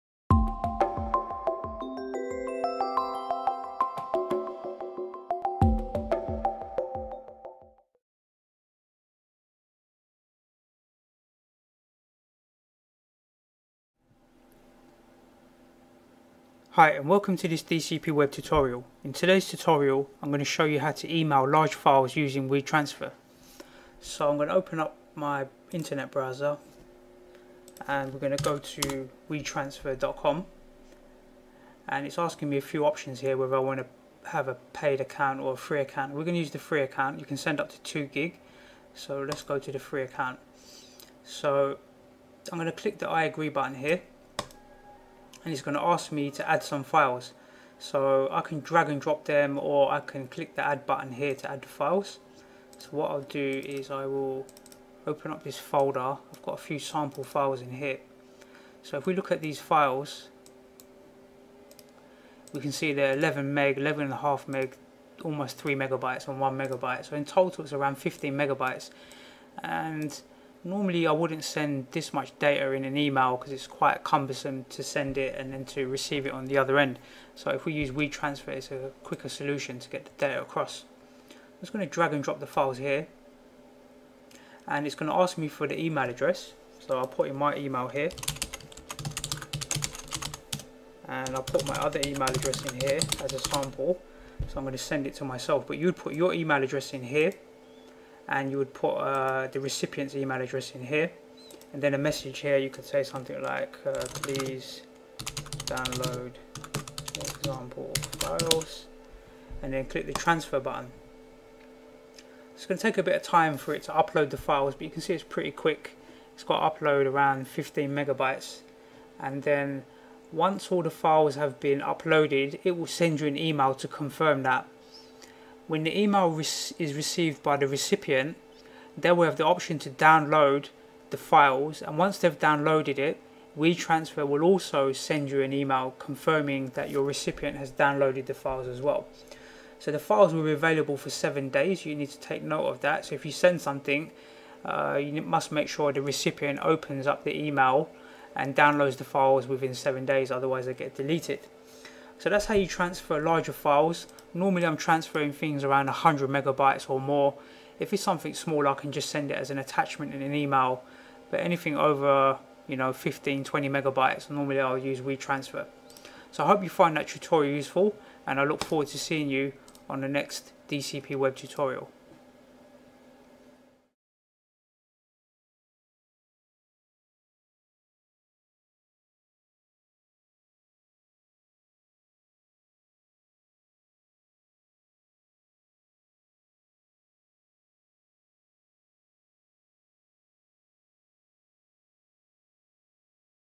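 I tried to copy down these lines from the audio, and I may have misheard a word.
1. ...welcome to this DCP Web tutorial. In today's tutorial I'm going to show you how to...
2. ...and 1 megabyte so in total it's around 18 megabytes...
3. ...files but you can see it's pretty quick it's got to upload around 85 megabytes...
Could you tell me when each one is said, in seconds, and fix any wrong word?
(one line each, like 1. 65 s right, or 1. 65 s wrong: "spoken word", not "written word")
1. 17 s right
2. 66 s wrong: "15", not "18"
3. 114 s wrong: "15", not "85".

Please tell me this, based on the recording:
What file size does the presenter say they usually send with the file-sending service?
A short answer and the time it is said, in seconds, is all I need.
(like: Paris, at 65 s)
100 megabytes, at 155 s.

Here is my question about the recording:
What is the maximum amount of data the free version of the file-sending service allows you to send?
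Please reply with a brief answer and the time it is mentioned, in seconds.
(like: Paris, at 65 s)
2 gig, at 37 s.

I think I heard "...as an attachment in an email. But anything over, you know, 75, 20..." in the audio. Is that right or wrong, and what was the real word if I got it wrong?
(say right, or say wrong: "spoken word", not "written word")
wrong: "15", not "75".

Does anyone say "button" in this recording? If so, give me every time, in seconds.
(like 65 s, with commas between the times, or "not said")
43 s, 50 s, 110 s.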